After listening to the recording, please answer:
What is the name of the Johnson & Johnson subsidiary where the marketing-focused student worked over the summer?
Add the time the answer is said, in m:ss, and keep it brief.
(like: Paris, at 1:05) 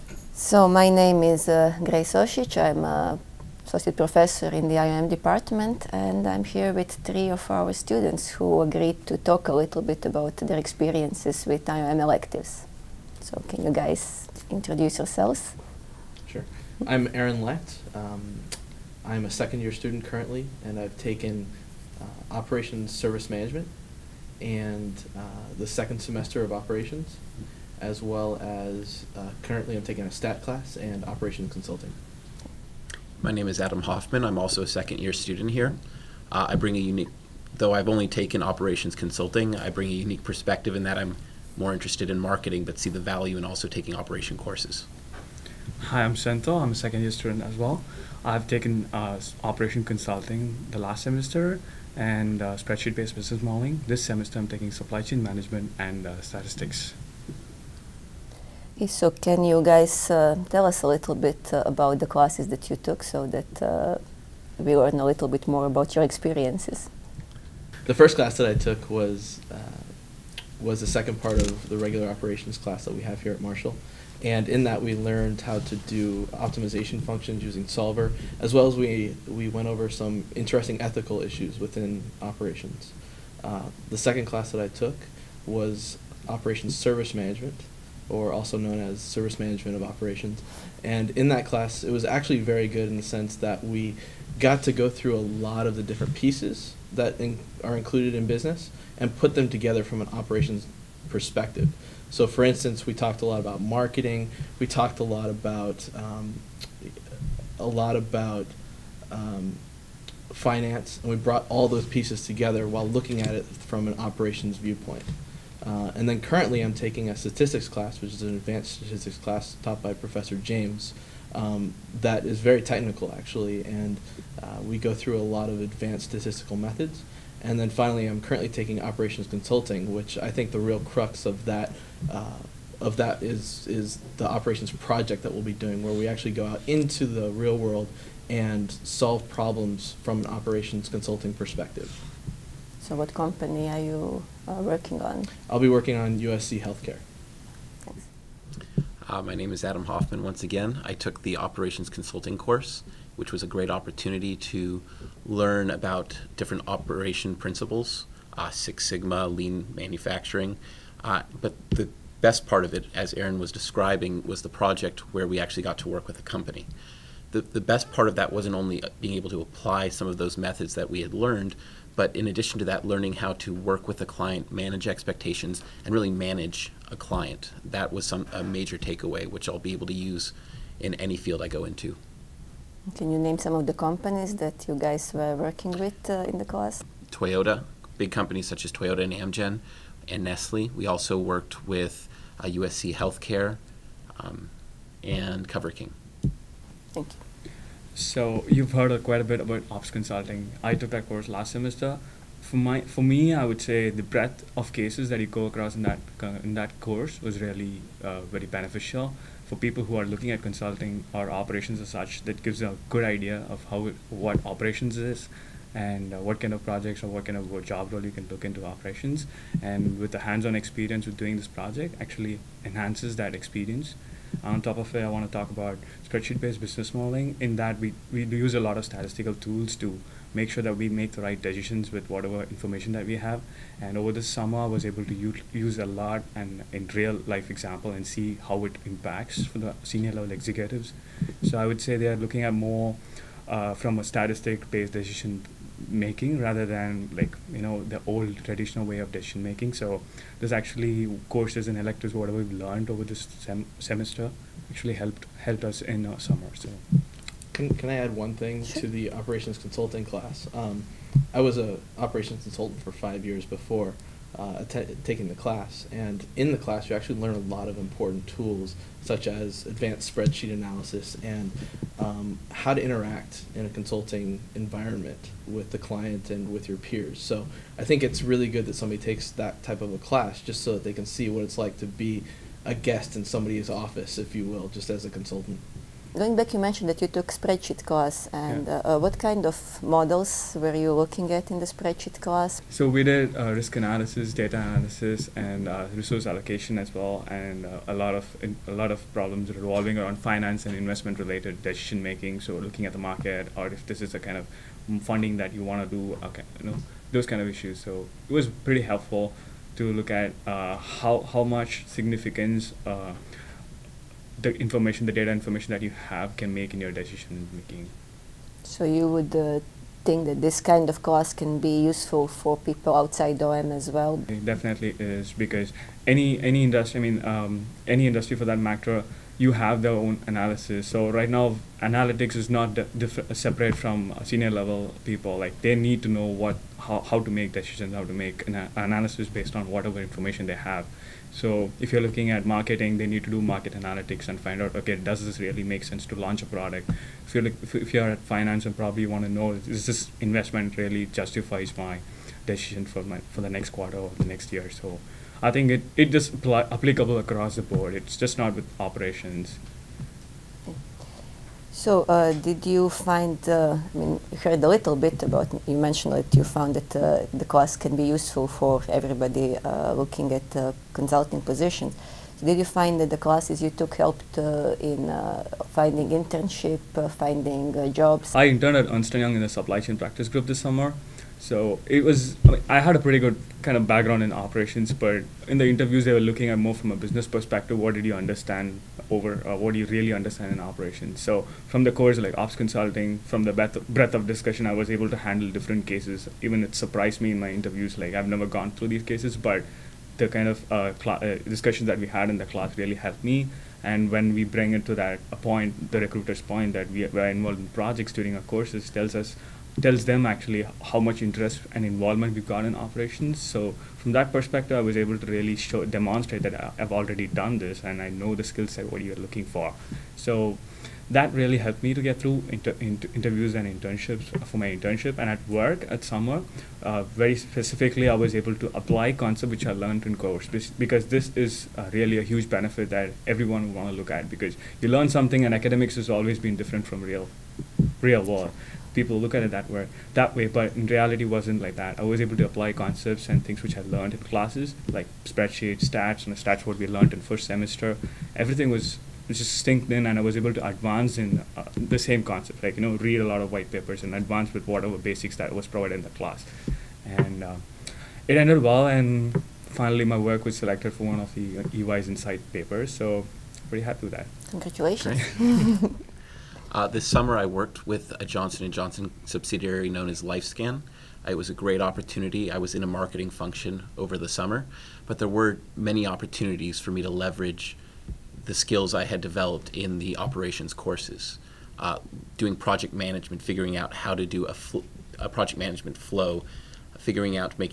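LifeScan, at 7:50.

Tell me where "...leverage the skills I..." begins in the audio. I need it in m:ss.
7:57.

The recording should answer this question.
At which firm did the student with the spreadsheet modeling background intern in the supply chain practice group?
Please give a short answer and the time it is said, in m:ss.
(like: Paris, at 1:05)
Ernst Young, at 6:18.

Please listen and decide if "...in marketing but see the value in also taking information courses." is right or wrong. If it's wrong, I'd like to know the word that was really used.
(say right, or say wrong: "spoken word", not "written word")
wrong: "operation", not "information".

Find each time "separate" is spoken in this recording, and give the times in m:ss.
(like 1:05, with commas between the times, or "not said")
5:33.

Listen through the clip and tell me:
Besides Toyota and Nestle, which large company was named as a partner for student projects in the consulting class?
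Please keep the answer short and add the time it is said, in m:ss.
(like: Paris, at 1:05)
Amgen, at 3:09.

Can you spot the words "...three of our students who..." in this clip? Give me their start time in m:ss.
0:07.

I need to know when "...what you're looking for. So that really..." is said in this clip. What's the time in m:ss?
6:58.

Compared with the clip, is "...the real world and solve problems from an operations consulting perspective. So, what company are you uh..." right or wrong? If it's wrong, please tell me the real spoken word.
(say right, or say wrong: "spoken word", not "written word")
right.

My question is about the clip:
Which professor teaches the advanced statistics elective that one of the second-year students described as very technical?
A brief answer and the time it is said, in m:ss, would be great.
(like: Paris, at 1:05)
Professor James, at 1:59.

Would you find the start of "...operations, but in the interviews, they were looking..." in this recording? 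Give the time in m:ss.
6:24.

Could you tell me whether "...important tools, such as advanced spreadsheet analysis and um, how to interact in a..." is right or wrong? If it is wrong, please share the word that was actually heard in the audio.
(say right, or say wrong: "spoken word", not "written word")
right.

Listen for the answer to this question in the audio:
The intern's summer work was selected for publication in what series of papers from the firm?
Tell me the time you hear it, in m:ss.
7:42.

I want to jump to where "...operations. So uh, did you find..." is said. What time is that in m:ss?
5:58.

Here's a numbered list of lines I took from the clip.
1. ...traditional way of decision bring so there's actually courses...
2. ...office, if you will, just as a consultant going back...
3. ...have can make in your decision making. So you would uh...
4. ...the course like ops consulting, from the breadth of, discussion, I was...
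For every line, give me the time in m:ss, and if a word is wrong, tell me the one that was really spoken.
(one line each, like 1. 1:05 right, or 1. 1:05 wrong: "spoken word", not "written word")
1. 4:08 wrong: "making", not "bring"
2. 4:43 right
3. 5:15 right
4. 6:31 right.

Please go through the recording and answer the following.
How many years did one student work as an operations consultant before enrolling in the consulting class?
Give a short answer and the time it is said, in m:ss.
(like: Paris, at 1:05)
5, at 4:22.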